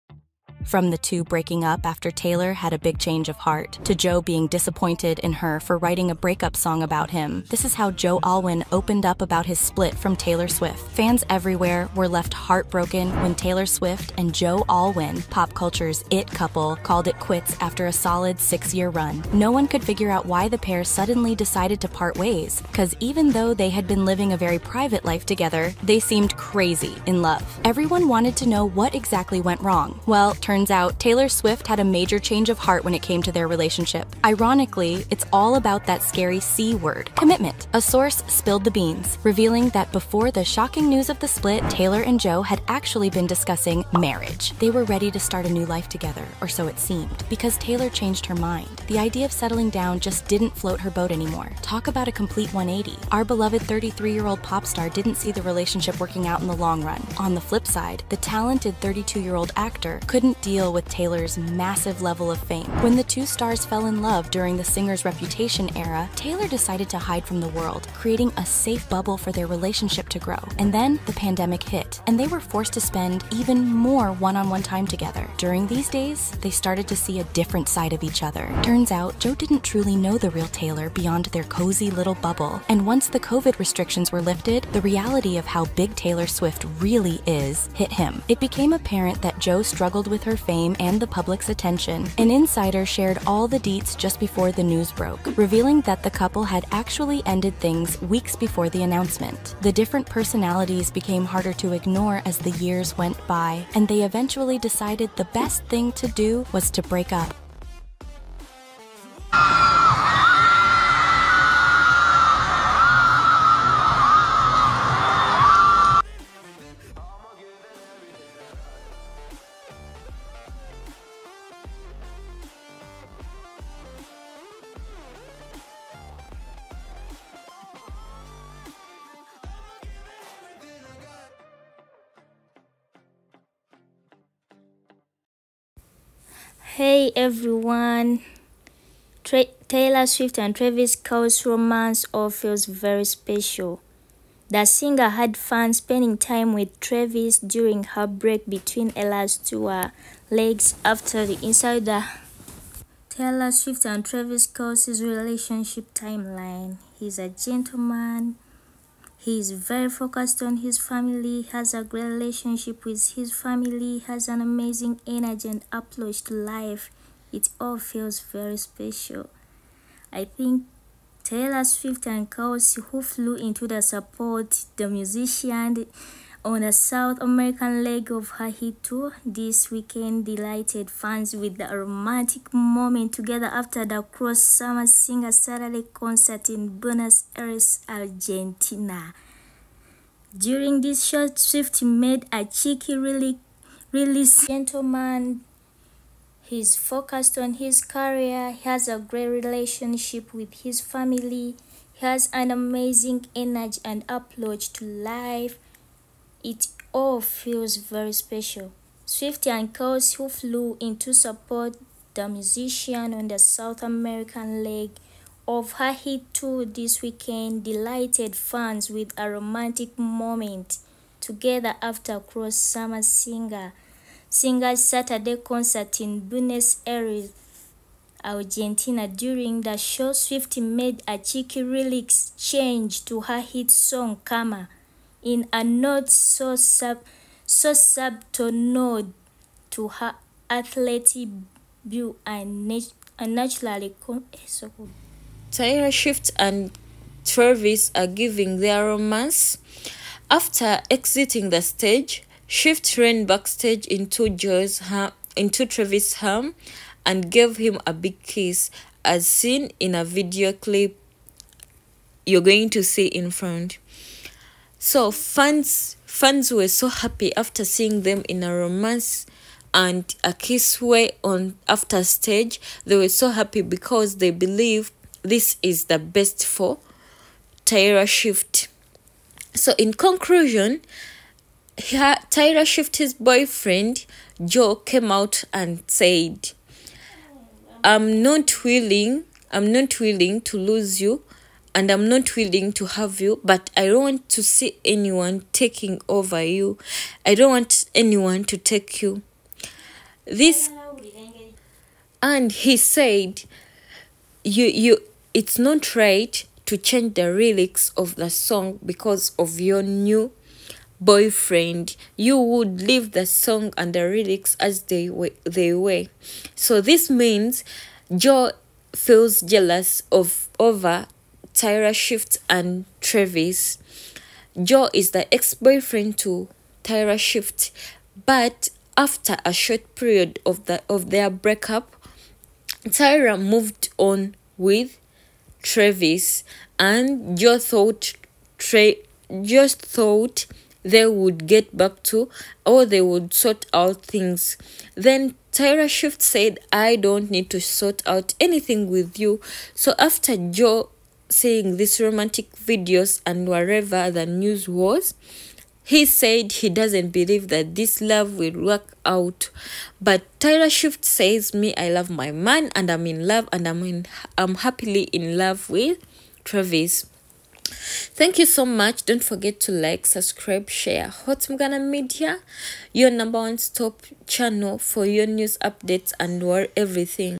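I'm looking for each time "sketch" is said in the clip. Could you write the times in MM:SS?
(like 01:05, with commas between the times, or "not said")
not said.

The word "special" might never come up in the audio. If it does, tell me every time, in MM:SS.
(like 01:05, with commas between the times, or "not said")
02:23, 02:48, 03:28.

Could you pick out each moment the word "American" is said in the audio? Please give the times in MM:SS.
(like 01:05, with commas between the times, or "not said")
02:57, 03:33.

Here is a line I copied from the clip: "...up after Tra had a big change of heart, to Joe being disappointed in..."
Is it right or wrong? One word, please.
wrong.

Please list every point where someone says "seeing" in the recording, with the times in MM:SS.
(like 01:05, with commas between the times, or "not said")
04:27, 05:51.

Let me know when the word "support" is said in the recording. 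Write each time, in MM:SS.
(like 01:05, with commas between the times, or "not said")
02:53, 03:31.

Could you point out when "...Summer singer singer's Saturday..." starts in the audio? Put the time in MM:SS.
03:42.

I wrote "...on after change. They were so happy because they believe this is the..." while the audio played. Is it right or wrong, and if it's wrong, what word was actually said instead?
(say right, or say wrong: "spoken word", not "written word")
wrong: "stage", not "change".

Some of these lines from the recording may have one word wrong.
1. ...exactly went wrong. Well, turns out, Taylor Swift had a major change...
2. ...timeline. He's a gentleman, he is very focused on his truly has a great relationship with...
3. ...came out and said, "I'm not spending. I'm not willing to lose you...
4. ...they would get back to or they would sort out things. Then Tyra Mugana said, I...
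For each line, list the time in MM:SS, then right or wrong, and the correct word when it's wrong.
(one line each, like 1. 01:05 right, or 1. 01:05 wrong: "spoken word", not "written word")
1. 00:28 right
2. 02:35 wrong: "family", not "truly"
3. 04:44 wrong: "willing", not "spending"
4. 05:40 wrong: "Shift", not "Mugana".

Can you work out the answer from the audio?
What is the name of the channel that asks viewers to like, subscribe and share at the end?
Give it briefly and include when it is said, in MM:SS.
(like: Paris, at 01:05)
Hot Mugana Media, at 06:11.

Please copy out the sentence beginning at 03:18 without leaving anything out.
He has a great relationship with his family.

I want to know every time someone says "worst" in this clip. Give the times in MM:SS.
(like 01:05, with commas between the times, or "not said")
not said.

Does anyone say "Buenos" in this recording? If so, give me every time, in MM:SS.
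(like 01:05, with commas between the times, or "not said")
03:06, 03:46.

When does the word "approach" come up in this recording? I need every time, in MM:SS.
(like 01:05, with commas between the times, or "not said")
02:45, 03:24.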